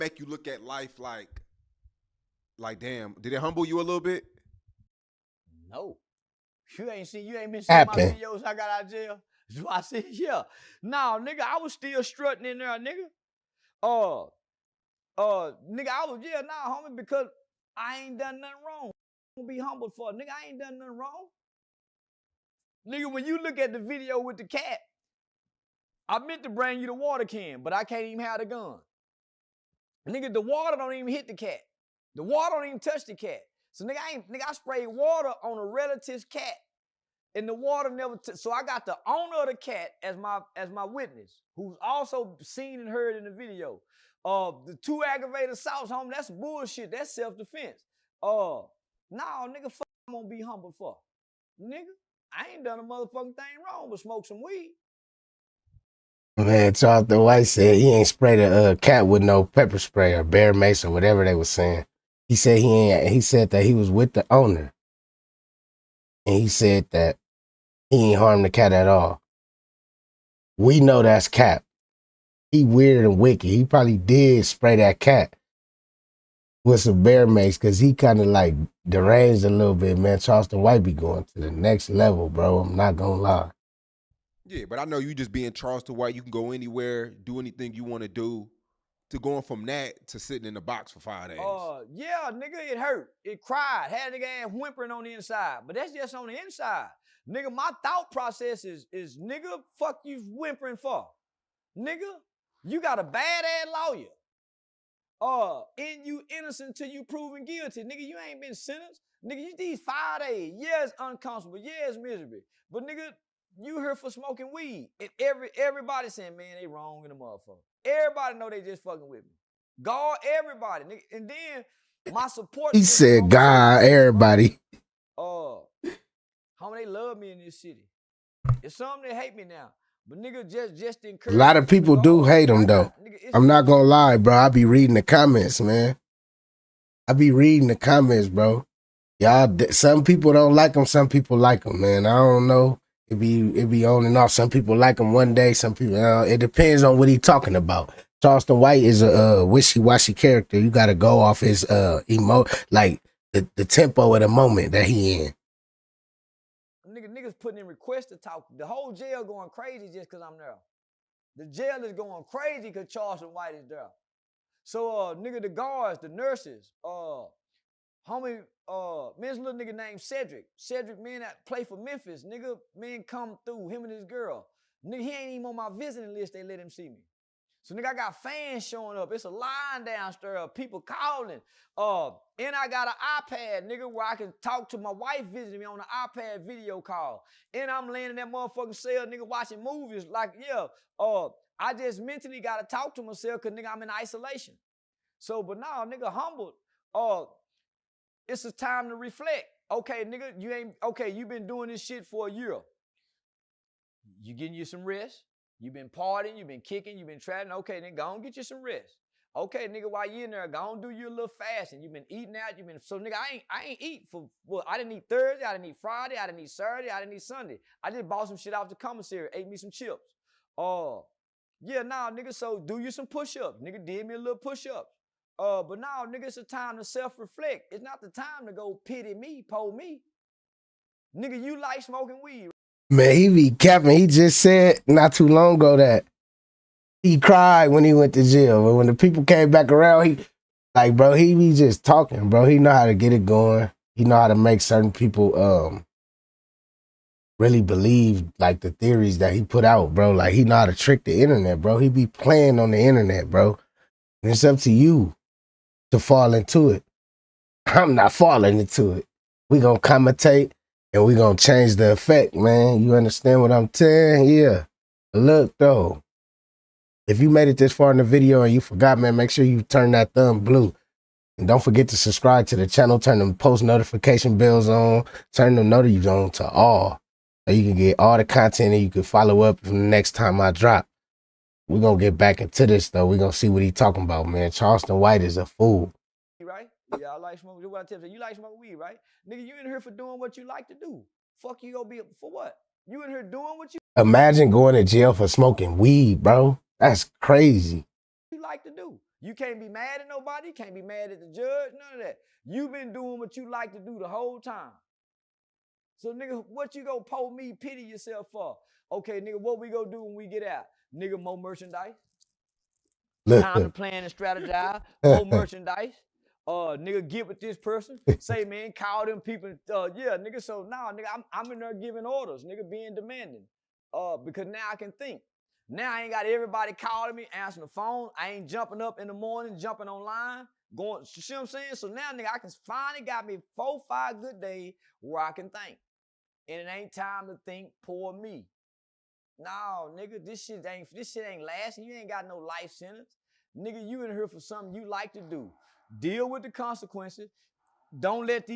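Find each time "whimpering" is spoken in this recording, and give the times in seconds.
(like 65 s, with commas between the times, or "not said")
94 s, 100 s.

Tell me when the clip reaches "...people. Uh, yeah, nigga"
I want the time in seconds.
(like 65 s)
319 s.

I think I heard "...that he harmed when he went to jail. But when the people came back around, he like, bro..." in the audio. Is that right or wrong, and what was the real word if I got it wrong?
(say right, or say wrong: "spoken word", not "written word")
wrong: "cried", not "harmed".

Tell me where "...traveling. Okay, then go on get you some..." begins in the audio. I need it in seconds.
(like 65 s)
207 s.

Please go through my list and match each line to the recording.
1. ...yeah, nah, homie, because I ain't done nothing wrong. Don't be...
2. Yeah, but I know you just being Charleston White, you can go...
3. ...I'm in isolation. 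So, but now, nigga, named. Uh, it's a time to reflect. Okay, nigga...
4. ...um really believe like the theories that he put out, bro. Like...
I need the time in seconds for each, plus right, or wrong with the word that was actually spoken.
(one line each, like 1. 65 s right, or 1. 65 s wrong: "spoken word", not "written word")
1. 16 s right
2. 84 s right
3. 193 s wrong: "humbled", not "named"
4. 245 s right.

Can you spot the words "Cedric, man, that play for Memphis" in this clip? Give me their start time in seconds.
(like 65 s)
170 s.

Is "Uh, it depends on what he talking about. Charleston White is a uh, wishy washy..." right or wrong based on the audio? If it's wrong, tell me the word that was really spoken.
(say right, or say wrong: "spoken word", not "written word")
right.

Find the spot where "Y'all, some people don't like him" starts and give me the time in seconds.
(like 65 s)
139 s.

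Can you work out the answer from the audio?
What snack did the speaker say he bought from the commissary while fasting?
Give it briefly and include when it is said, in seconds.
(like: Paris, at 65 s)
Chips, at 219 s.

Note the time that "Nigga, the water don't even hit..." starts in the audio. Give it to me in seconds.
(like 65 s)
30 s.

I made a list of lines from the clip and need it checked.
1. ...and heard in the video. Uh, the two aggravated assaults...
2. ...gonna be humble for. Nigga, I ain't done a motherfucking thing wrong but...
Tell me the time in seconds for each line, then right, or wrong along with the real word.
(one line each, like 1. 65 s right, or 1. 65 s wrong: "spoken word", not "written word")
1. 42 s right
2. 50 s right.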